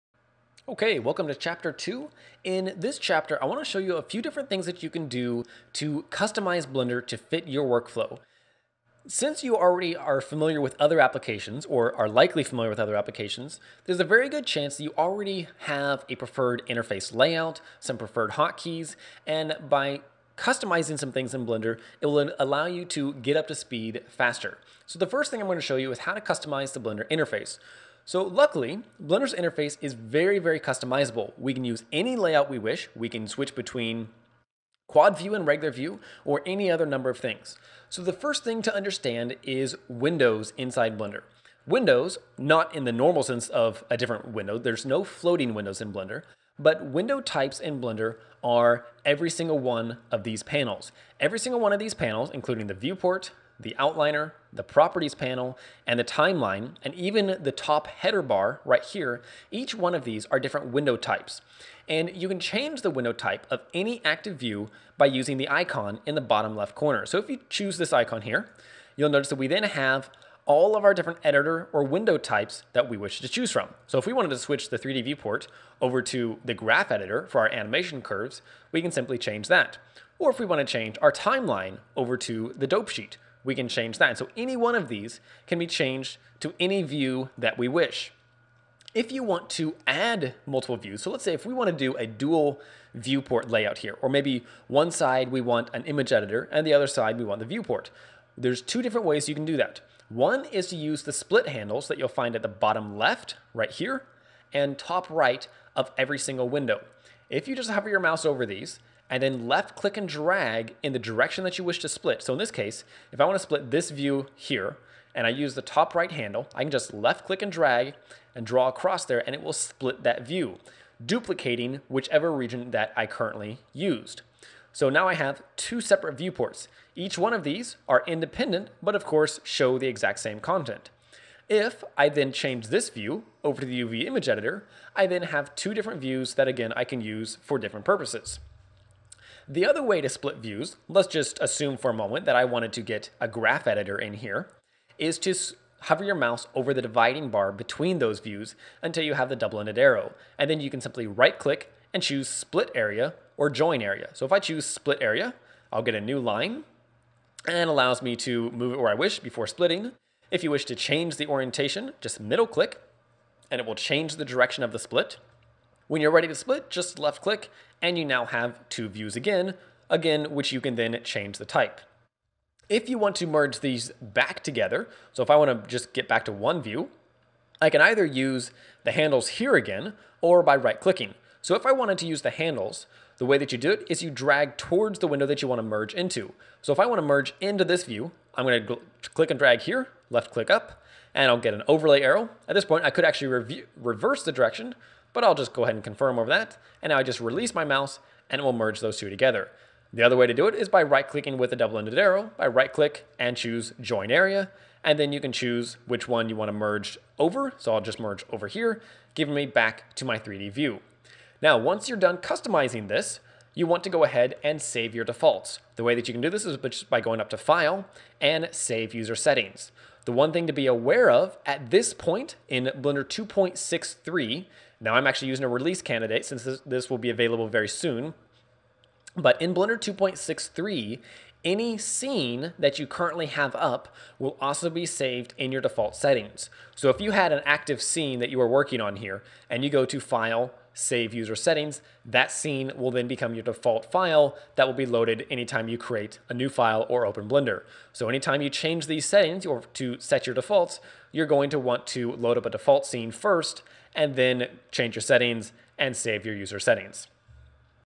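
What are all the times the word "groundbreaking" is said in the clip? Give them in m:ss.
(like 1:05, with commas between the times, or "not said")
not said.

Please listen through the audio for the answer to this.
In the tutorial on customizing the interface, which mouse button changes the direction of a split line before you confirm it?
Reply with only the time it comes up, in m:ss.
2:42.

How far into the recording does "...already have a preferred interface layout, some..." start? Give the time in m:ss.
0:14.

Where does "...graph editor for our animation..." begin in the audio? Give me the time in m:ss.
1:16.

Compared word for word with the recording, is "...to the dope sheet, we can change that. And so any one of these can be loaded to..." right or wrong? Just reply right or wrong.
wrong.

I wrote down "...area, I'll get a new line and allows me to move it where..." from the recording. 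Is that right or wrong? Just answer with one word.
right.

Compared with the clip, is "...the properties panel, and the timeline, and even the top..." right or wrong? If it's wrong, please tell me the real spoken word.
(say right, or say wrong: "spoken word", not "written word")
right.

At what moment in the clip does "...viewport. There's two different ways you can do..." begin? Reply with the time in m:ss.
1:37.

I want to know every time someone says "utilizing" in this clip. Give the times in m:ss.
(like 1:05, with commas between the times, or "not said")
not said.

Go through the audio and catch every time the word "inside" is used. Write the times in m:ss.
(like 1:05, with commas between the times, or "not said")
0:40.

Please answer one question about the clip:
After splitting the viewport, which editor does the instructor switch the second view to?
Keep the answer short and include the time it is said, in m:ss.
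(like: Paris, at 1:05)
UV image editor, at 2:13.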